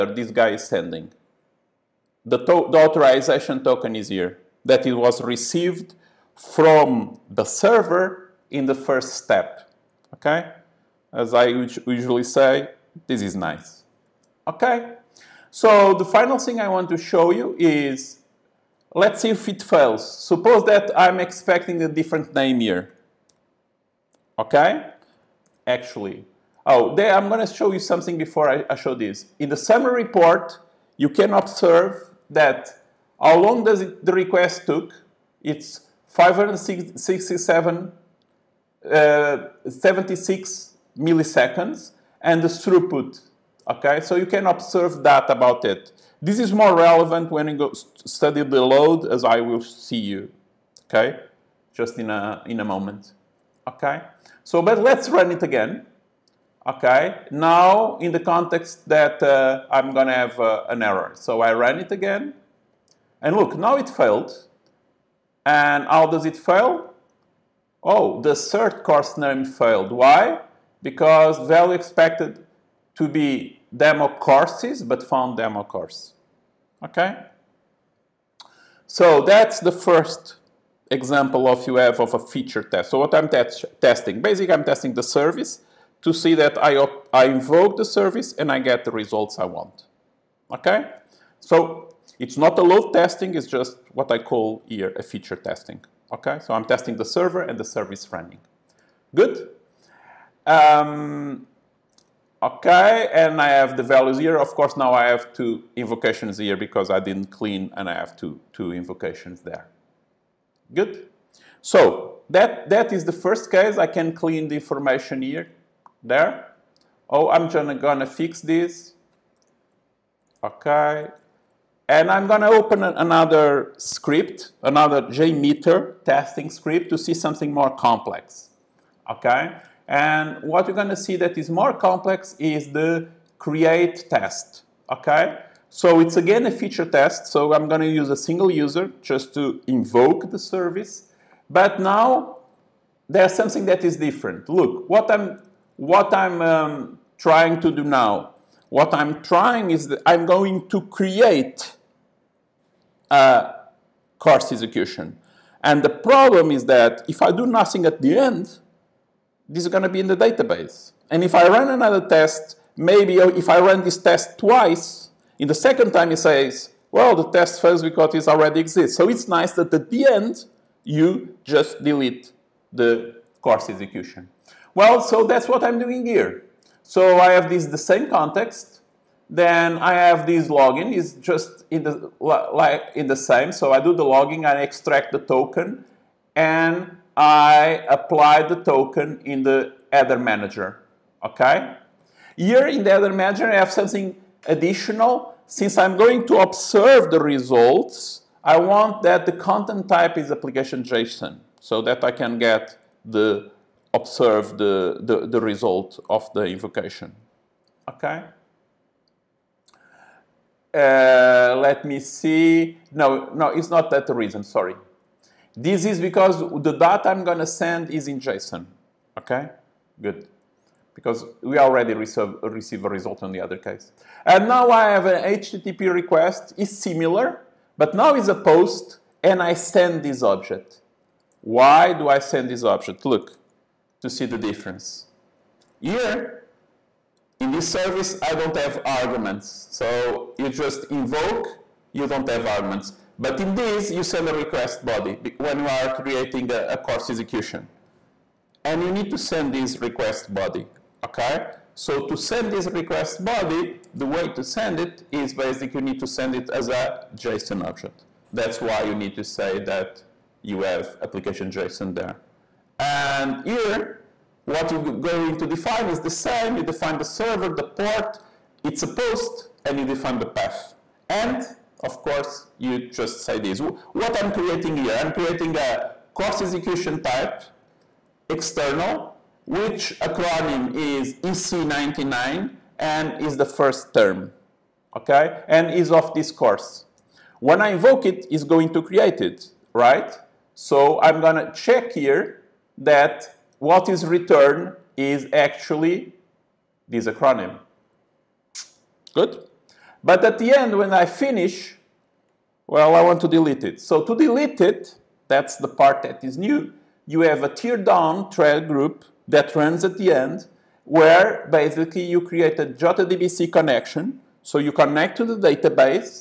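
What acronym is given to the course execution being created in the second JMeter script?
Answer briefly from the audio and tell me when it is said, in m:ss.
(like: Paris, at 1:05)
EC99, at 4:41.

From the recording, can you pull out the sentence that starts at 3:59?
So you just invoke, you don't have arguments.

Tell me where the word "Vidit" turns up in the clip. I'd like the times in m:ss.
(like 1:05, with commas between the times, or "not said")
not said.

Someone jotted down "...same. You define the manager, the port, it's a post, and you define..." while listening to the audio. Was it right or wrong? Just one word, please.
wrong.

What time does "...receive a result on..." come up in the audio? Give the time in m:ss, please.
3:42.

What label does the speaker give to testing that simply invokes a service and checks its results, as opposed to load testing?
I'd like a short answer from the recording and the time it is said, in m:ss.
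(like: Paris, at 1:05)
feature testing, at 1:35.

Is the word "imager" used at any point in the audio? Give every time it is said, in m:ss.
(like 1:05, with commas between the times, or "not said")
not said.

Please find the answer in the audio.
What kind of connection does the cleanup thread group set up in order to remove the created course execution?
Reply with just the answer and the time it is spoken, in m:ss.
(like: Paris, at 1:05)
JDBC connection, at 5:12.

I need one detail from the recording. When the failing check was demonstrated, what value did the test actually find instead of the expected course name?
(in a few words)
demo course.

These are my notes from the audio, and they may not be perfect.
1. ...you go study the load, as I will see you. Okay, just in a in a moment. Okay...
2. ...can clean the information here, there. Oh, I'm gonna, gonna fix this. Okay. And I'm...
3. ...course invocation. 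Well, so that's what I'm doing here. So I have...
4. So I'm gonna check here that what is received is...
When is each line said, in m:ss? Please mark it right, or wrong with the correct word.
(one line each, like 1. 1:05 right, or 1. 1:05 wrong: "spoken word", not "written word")
1. 0:47 right
2. 1:53 right
3. 2:53 wrong: "execution", not "invocation"
4. 4:50 wrong: "returned", not "received".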